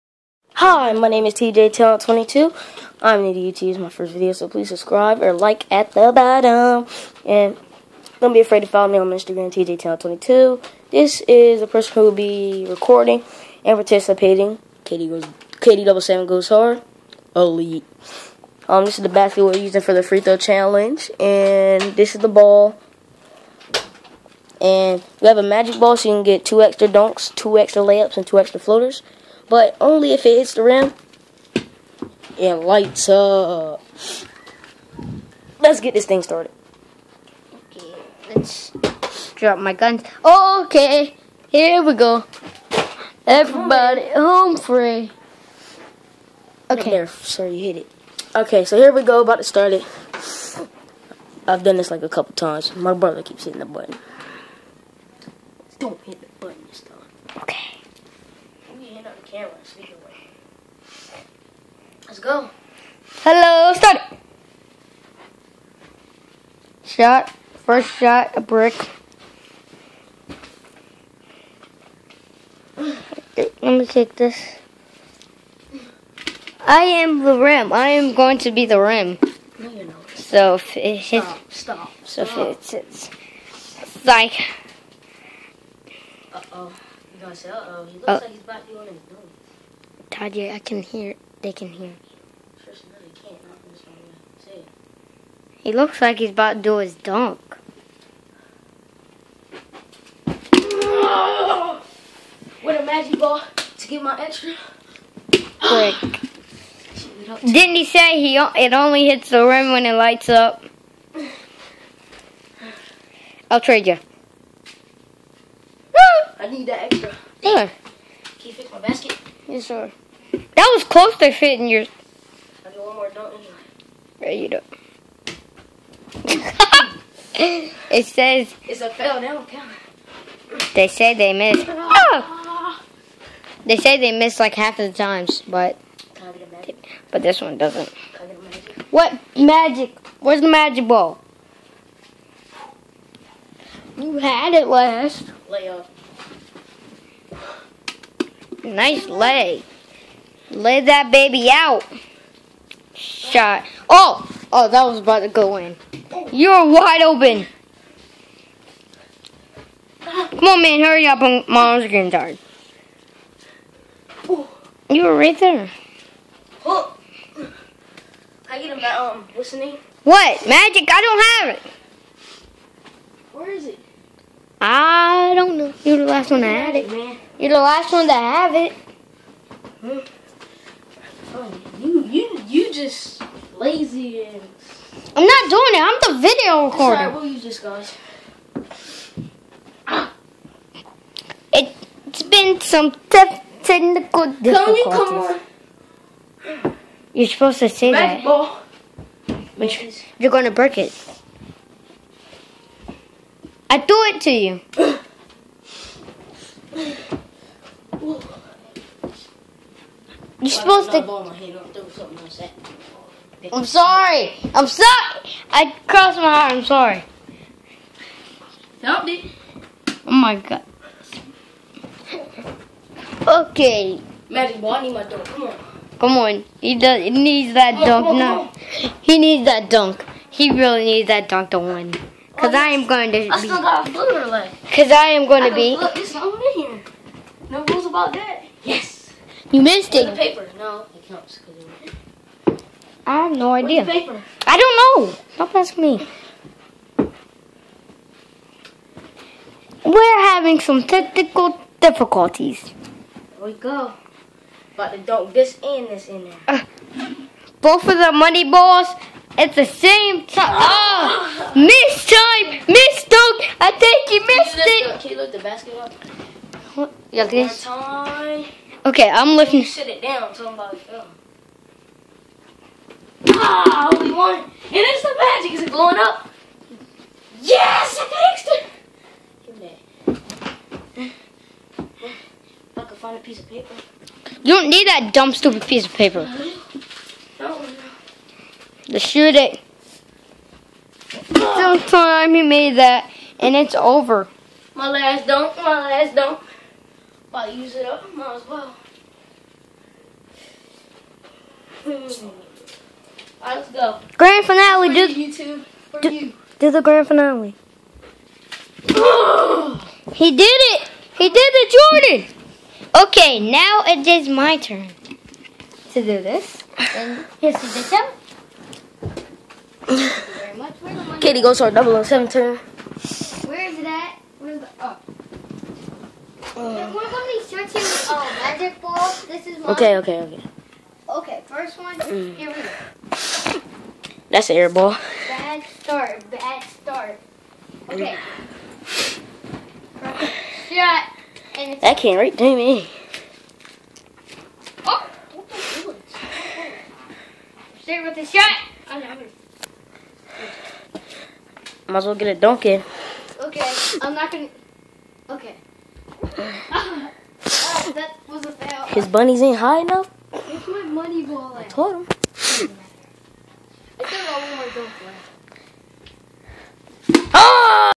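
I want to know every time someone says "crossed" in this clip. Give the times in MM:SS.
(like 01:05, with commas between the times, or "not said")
03:35.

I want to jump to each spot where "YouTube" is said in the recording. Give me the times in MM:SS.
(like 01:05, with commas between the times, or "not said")
00:03, 05:05.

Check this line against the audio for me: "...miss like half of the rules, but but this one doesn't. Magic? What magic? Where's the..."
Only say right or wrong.
wrong.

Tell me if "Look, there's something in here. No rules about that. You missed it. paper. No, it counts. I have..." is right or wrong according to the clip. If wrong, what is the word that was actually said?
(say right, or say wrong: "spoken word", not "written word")
right.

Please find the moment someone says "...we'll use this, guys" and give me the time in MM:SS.
03:07.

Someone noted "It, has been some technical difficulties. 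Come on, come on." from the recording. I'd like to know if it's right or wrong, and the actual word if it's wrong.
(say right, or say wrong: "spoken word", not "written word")
right.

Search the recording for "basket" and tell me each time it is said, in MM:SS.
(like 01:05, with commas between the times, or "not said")
00:19, 01:58, 04:25.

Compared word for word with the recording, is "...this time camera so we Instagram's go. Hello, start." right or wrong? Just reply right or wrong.
wrong.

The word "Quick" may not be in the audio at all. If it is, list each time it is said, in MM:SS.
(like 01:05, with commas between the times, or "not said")
01:45.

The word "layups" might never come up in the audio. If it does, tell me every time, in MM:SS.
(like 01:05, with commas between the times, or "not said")
00:27, 02:25.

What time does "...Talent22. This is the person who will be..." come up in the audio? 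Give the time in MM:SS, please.
00:09.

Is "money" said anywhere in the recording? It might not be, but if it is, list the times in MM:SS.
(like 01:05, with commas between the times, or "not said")
04:18, 06:00.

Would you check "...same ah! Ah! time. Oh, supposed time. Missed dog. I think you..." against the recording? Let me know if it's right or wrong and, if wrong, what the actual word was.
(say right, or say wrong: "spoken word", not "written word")
wrong: "missed", not "supposed".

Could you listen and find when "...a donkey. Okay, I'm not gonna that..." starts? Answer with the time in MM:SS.
05:52.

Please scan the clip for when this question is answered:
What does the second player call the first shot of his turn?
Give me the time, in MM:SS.
05:34.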